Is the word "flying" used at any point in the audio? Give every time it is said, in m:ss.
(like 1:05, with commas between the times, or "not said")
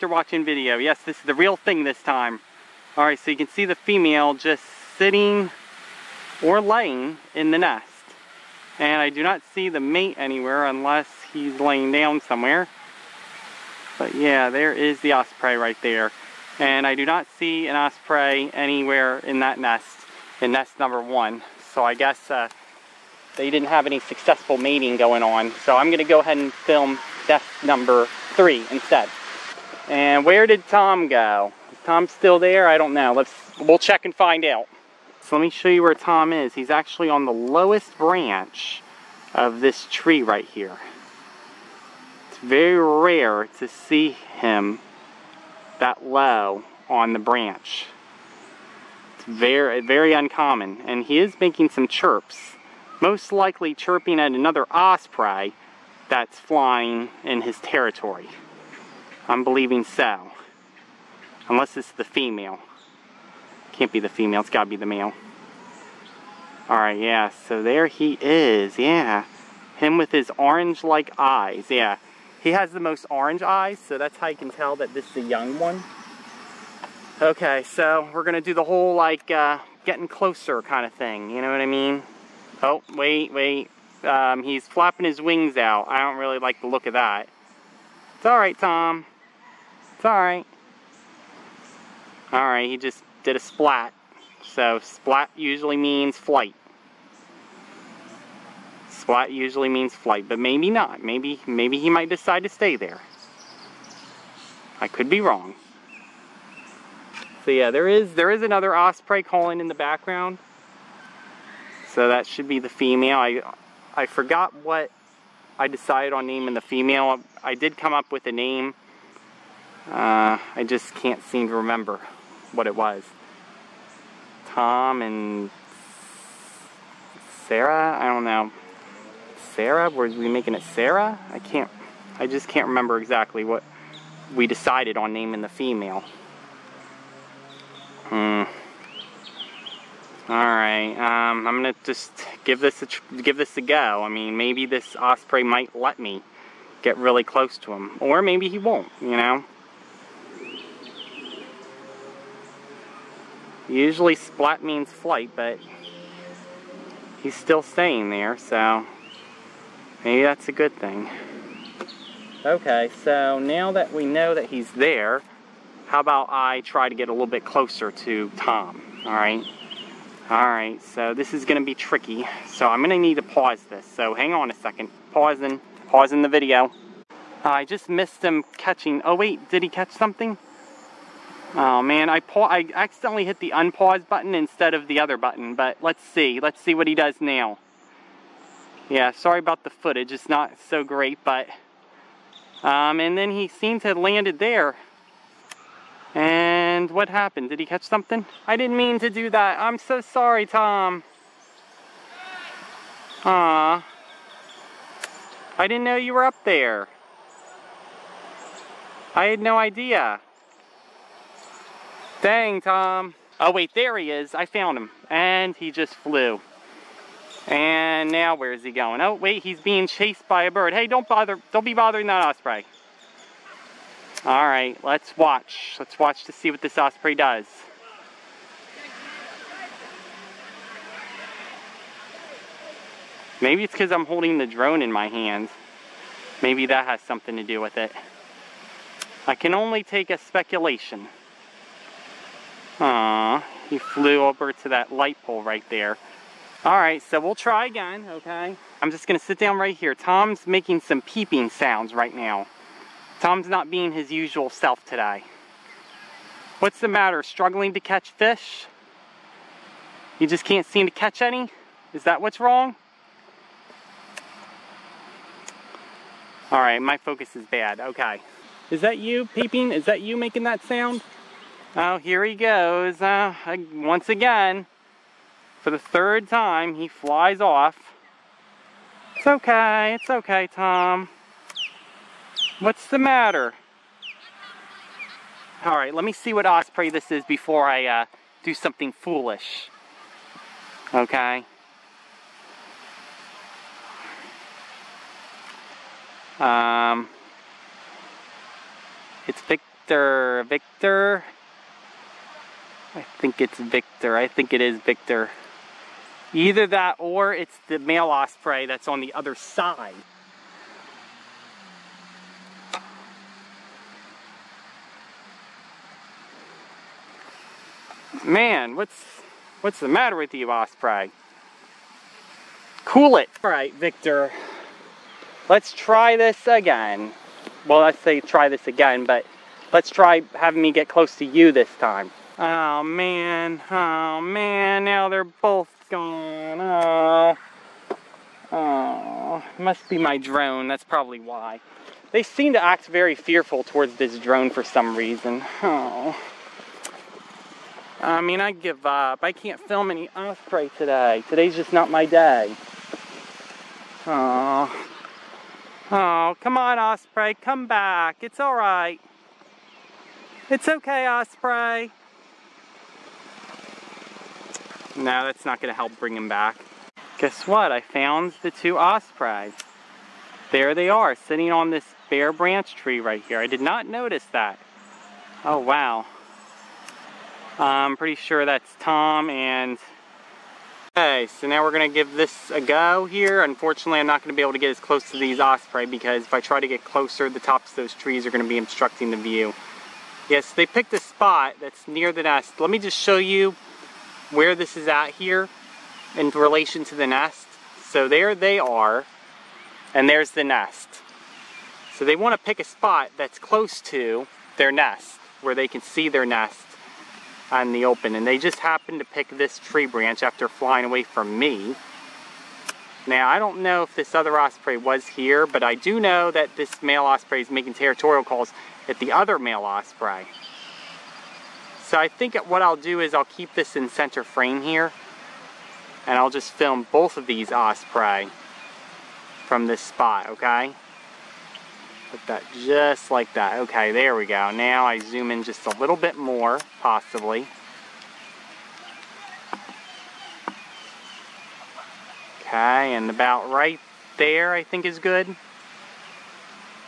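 0:56, 6:50.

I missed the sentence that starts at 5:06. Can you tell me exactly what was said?
Either that or it's the male osprey that's on the other side.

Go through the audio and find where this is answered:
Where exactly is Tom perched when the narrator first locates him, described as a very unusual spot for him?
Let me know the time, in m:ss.
0:37.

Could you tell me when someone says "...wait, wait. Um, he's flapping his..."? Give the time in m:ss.
1:22.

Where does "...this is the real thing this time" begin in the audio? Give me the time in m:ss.
0:01.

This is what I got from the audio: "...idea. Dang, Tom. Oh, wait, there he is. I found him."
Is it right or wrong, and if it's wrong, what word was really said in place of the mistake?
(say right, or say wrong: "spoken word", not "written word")
right.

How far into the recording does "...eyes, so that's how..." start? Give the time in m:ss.
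1:13.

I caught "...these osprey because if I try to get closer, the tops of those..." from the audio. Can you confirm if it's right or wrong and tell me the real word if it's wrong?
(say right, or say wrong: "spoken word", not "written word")
right.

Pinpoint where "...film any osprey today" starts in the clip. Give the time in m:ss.
5:49.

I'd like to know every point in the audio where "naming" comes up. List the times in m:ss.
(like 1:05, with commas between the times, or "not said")
1:56, 2:15.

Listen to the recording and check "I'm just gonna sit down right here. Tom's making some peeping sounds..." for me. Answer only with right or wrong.
right.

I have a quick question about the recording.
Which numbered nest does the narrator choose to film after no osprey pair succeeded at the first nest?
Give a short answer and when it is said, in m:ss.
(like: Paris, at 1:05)
nest number three, at 0:27.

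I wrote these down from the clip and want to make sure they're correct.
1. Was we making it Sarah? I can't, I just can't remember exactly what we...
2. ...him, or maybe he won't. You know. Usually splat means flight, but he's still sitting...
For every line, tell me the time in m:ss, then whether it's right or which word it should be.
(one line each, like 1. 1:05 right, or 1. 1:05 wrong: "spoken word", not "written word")
1. 2:09 right
2. 2:27 wrong: "staying", not "sitting".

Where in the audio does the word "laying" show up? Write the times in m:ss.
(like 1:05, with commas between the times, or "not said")
0:06, 0:11.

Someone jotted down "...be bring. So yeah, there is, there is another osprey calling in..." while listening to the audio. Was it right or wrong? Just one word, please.
wrong.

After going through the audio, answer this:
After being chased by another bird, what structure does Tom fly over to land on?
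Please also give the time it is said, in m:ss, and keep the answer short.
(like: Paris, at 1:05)
light pole, at 4:04.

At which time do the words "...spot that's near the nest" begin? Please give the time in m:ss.
6:30.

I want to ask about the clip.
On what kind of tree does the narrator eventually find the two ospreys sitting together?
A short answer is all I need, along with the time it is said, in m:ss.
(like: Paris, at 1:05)
bare branch tree, at 6:12.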